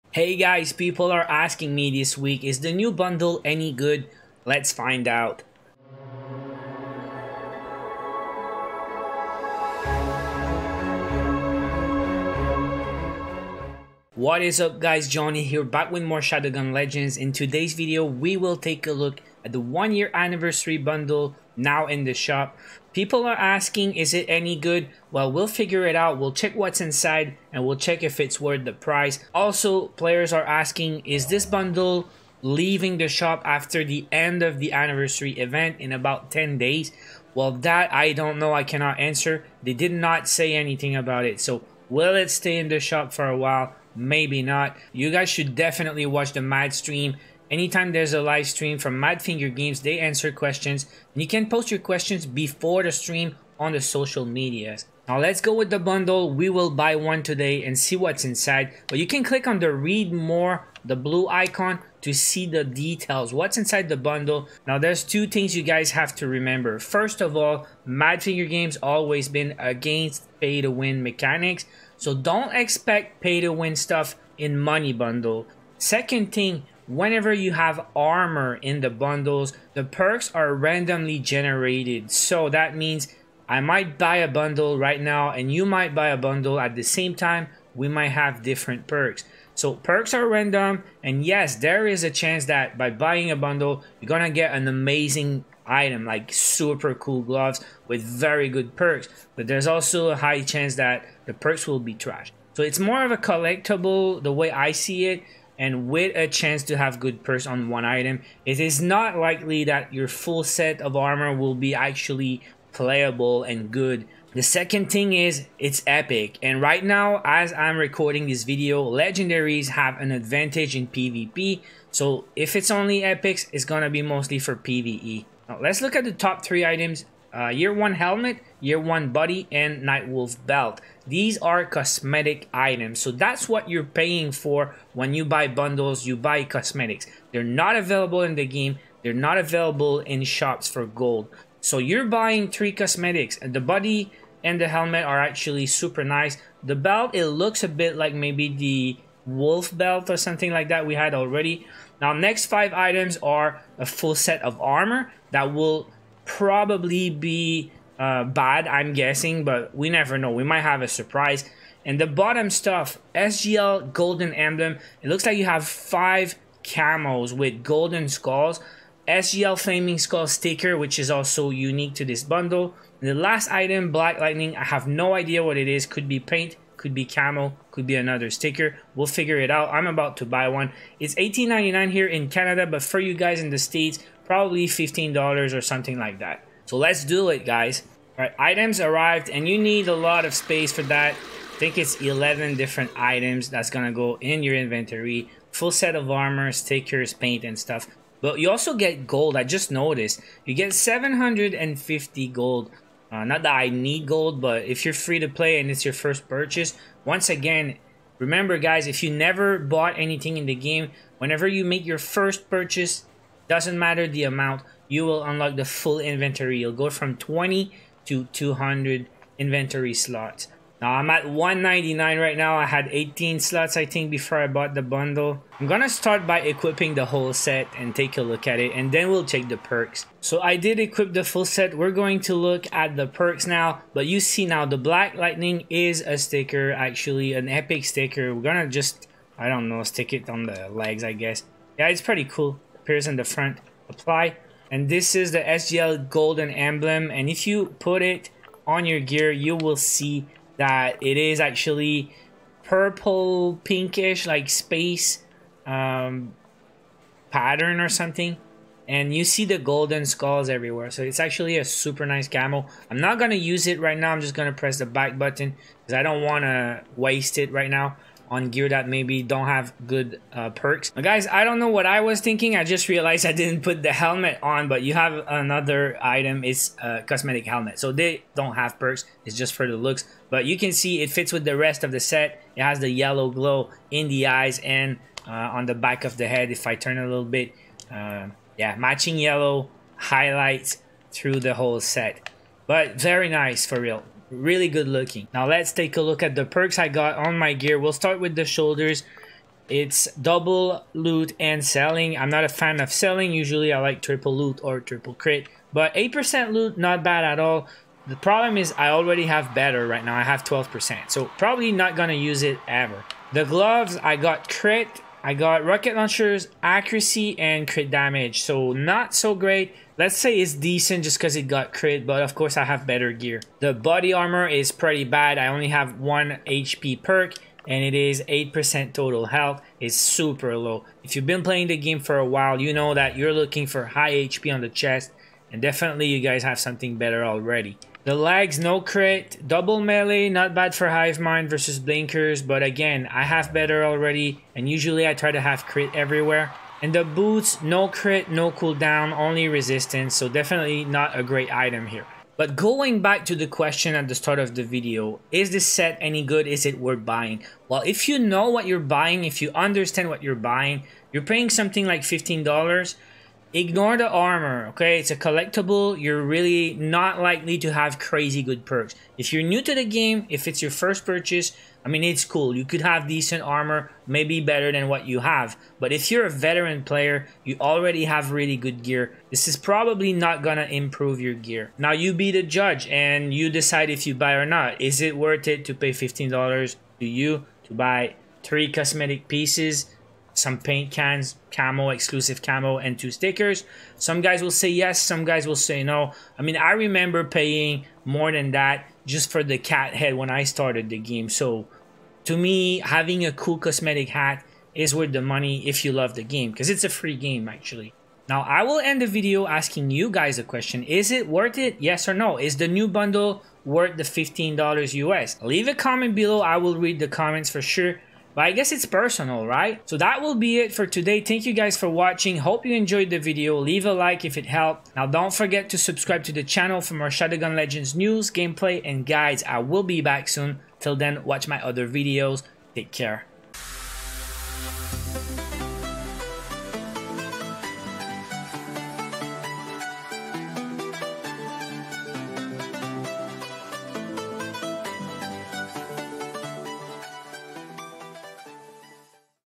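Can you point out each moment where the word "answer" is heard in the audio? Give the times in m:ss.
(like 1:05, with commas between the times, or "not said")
0:38, 0:49.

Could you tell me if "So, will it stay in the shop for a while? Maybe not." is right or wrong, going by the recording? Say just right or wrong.
right.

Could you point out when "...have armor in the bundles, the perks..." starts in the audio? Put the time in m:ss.
1:17.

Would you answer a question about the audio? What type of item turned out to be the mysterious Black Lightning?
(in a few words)
epic sticker.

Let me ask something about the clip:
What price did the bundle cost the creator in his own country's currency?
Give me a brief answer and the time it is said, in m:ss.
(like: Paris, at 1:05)
$18.99, at 3:01.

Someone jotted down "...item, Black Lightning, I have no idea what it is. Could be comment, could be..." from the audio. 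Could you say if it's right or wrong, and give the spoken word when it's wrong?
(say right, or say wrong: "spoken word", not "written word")
wrong: "paint", not "comment".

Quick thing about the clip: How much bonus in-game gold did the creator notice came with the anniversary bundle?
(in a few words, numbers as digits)
750.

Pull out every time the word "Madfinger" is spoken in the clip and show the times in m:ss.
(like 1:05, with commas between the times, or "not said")
0:48, 1:07.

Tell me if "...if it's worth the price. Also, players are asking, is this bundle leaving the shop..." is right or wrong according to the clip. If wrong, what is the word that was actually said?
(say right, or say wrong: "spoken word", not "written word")
right.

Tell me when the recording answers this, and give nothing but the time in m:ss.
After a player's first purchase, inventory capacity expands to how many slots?
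3:38.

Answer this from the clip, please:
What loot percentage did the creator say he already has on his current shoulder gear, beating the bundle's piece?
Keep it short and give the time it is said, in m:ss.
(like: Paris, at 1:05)
12%, at 5:10.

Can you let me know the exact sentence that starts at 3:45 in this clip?
I'm gonna start by equipping the whole set and take a look at it and then we'll check the perks.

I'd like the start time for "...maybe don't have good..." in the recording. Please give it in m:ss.
4:28.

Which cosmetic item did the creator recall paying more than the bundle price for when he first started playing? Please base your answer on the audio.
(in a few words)
cat head.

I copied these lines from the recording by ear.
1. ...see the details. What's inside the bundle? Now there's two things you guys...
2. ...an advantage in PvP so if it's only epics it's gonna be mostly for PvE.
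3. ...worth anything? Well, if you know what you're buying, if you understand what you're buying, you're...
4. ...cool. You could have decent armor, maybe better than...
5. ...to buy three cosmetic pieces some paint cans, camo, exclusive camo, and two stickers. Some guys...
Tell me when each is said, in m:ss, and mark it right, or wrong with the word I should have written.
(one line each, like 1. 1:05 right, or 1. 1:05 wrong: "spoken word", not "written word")
1. 1:02 right
2. 1:59 right
3. 5:56 wrong: "buying", not "anything"
4. 6:12 right
5. 6:27 right.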